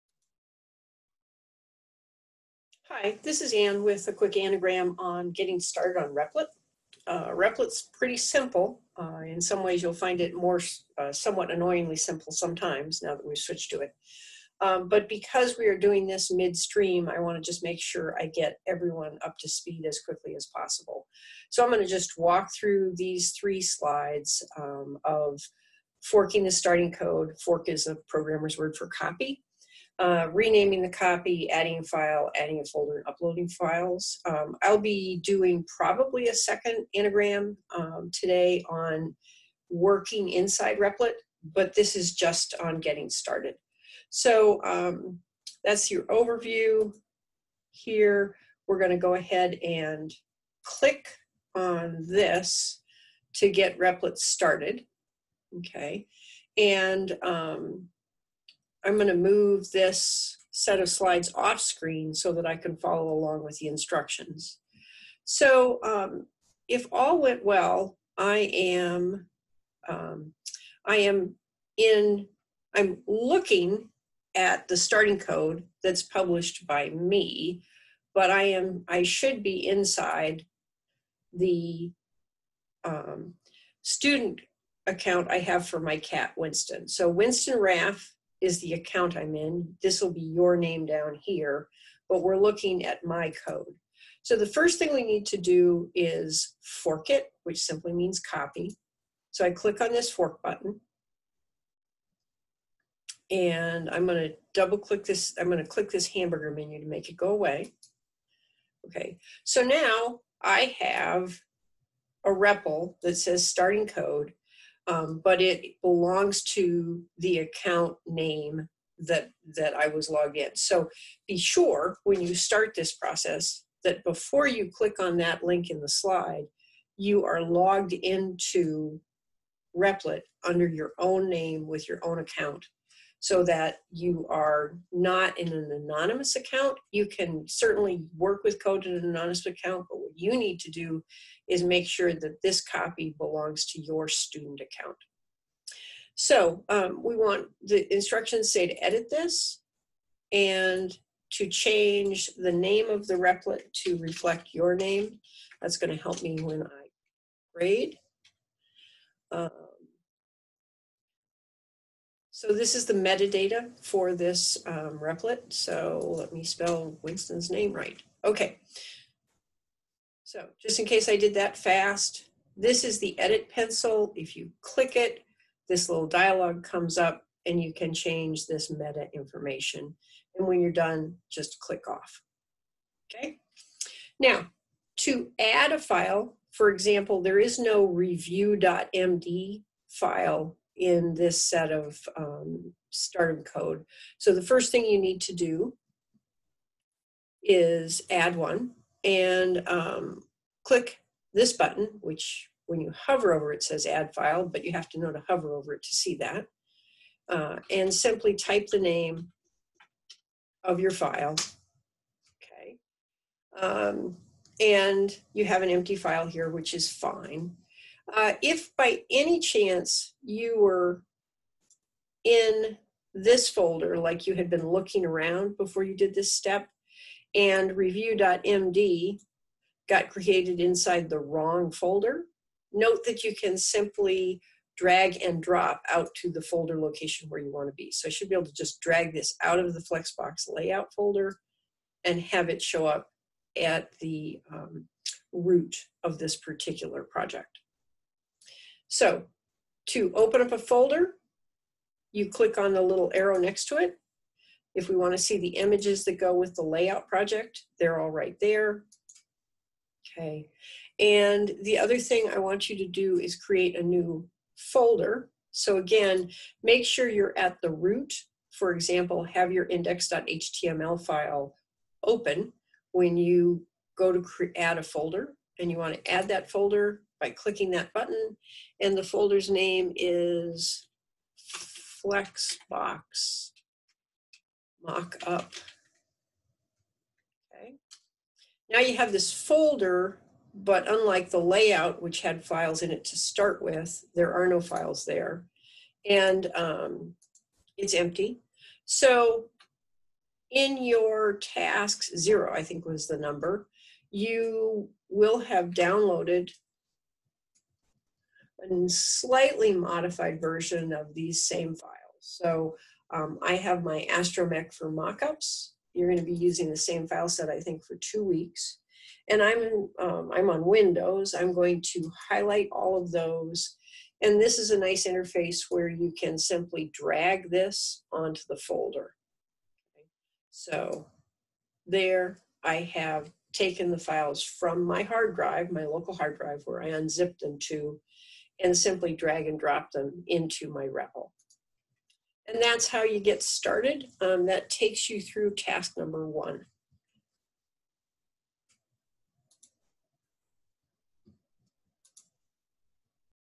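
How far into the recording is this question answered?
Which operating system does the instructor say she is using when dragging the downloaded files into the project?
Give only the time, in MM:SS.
05:20.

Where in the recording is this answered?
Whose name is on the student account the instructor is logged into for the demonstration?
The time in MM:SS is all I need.
01:27.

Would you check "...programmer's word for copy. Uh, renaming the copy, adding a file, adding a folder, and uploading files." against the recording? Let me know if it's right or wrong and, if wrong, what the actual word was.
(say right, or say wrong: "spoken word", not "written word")
right.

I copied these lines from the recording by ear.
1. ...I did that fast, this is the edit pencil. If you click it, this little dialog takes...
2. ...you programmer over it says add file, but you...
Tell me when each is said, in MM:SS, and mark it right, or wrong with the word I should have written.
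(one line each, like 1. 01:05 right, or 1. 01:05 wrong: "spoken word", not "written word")
1. 02:51 wrong: "comes", not "takes"
2. 03:22 wrong: "hover", not "programmer".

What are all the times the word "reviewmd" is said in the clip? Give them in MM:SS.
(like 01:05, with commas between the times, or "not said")
03:07, 03:47.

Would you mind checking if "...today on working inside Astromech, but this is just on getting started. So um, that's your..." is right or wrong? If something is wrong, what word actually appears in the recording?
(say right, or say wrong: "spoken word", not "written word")
wrong: "Replit", not "Astromech".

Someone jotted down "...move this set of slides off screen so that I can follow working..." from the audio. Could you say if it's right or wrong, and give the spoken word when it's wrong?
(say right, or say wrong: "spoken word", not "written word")
wrong: "along", not "working".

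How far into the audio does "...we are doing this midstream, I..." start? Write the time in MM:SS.
00:15.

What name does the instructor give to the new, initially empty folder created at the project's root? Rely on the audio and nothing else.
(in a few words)
Flexbox Mockup.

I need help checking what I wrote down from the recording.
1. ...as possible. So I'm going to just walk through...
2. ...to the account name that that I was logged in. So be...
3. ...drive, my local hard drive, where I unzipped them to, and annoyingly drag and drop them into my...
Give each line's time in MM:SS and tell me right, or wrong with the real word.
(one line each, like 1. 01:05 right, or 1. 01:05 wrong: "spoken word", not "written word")
1. 00:20 right
2. 01:56 right
3. 05:35 wrong: "simply", not "annoyingly".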